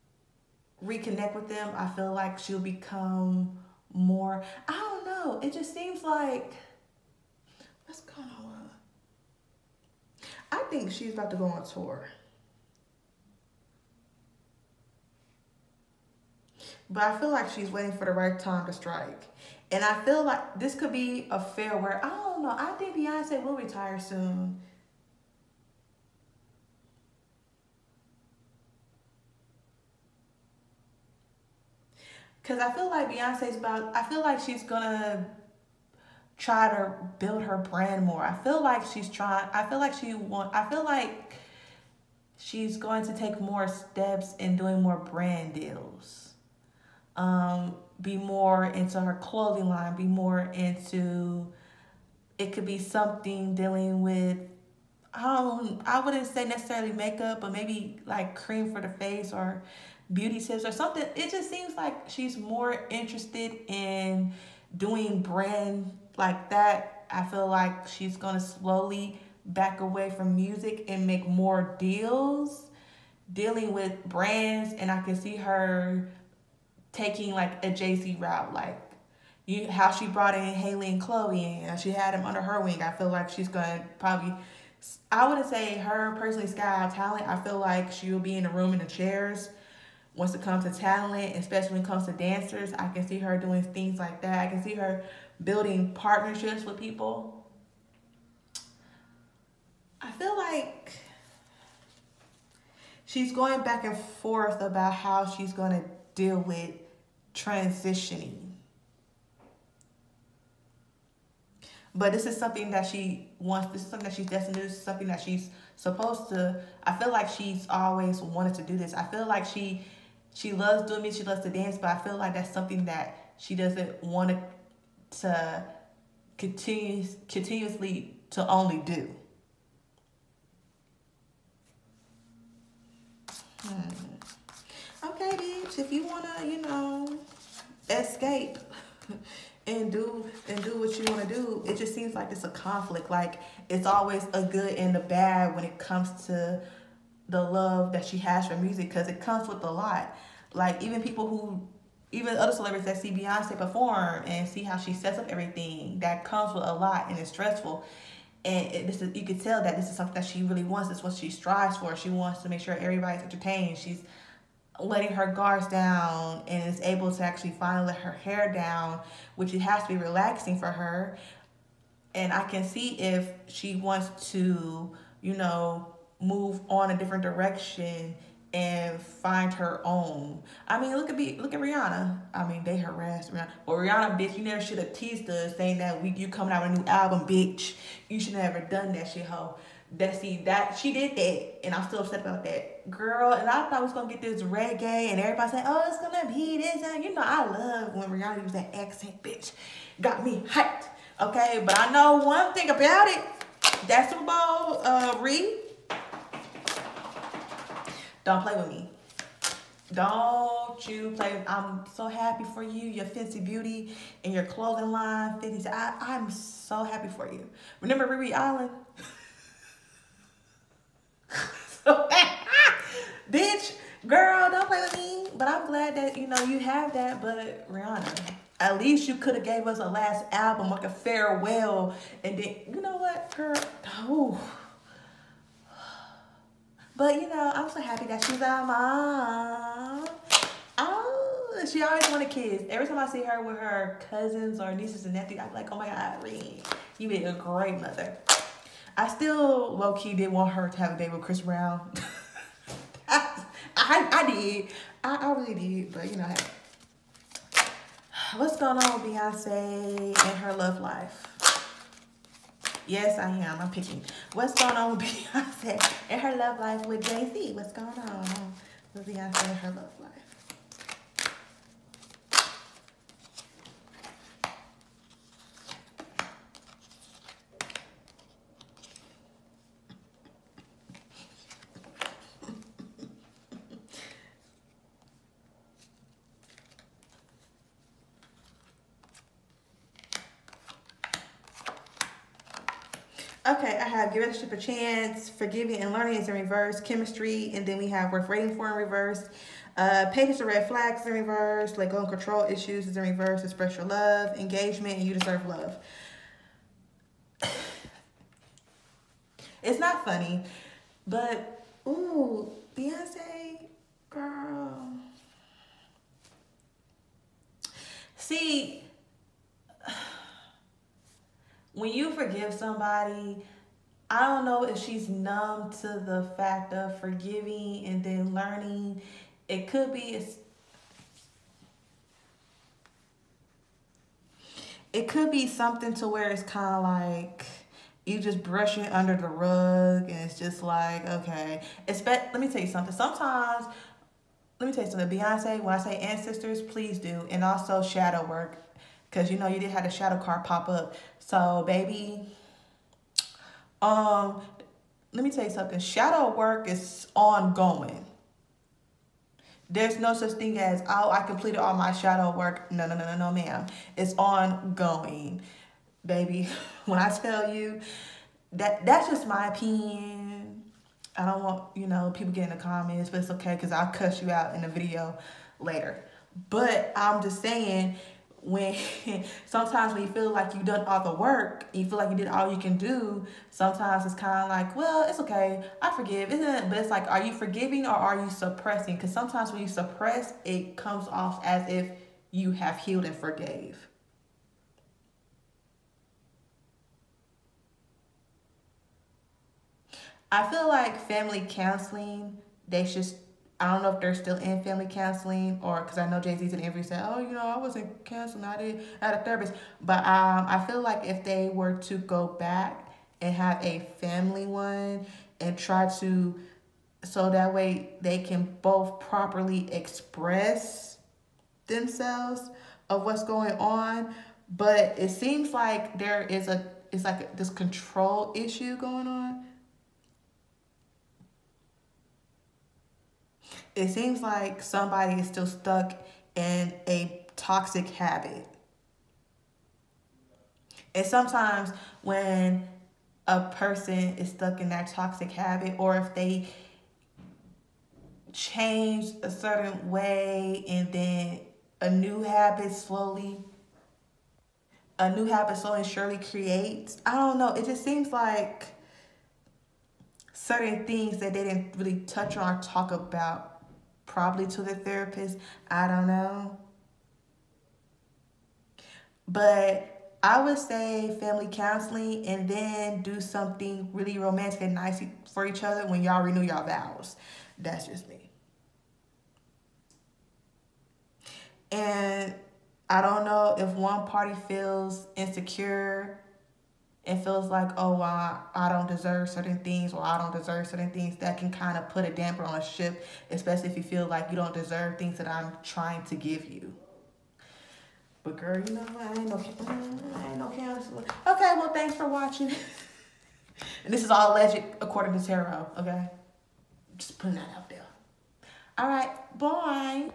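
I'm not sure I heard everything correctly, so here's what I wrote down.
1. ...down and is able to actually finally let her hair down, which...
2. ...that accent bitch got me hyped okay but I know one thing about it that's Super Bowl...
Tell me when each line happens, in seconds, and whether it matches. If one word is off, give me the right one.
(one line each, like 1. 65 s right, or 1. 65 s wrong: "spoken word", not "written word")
1. 165 s right
2. 198 s right.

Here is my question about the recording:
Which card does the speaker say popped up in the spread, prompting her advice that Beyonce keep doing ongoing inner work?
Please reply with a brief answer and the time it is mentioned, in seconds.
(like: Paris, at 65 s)
Shadow card, at 349 s.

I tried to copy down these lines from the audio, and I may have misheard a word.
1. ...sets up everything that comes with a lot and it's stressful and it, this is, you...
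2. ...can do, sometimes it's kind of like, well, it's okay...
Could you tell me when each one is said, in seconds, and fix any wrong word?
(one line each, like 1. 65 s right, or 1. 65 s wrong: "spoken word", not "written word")
1. 154 s right
2. 382 s right.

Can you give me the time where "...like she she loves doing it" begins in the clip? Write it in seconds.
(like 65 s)
119 s.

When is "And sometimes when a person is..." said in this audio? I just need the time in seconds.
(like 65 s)
440 s.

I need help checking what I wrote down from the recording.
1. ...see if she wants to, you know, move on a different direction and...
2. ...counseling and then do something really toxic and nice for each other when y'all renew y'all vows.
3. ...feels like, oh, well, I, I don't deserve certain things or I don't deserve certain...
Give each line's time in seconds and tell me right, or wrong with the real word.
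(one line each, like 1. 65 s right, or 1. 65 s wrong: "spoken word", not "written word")
1. 172 s right
2. 471 s wrong: "romantic", not "toxic"
3. 487 s right.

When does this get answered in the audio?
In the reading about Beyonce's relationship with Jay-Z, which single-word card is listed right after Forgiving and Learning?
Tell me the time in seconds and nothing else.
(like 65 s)
296 s.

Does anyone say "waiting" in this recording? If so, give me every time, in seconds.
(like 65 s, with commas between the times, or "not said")
17 s, 298 s.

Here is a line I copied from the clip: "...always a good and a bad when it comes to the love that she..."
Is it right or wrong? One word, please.
right.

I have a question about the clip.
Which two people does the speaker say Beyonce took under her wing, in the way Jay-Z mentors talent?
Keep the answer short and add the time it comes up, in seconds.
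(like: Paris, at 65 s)
Halle and Chloe, at 80 s.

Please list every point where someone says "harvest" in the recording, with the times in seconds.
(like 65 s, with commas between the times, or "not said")
not said.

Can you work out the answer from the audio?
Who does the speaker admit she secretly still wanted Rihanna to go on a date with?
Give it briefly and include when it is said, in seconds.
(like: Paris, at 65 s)
Chris Brown, at 251 s.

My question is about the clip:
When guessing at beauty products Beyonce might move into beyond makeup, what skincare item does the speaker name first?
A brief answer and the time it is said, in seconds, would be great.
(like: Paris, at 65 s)
Cream for the face, at 58 s.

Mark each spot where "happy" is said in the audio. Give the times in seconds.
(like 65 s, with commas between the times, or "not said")
212 s, 216 s, 237 s.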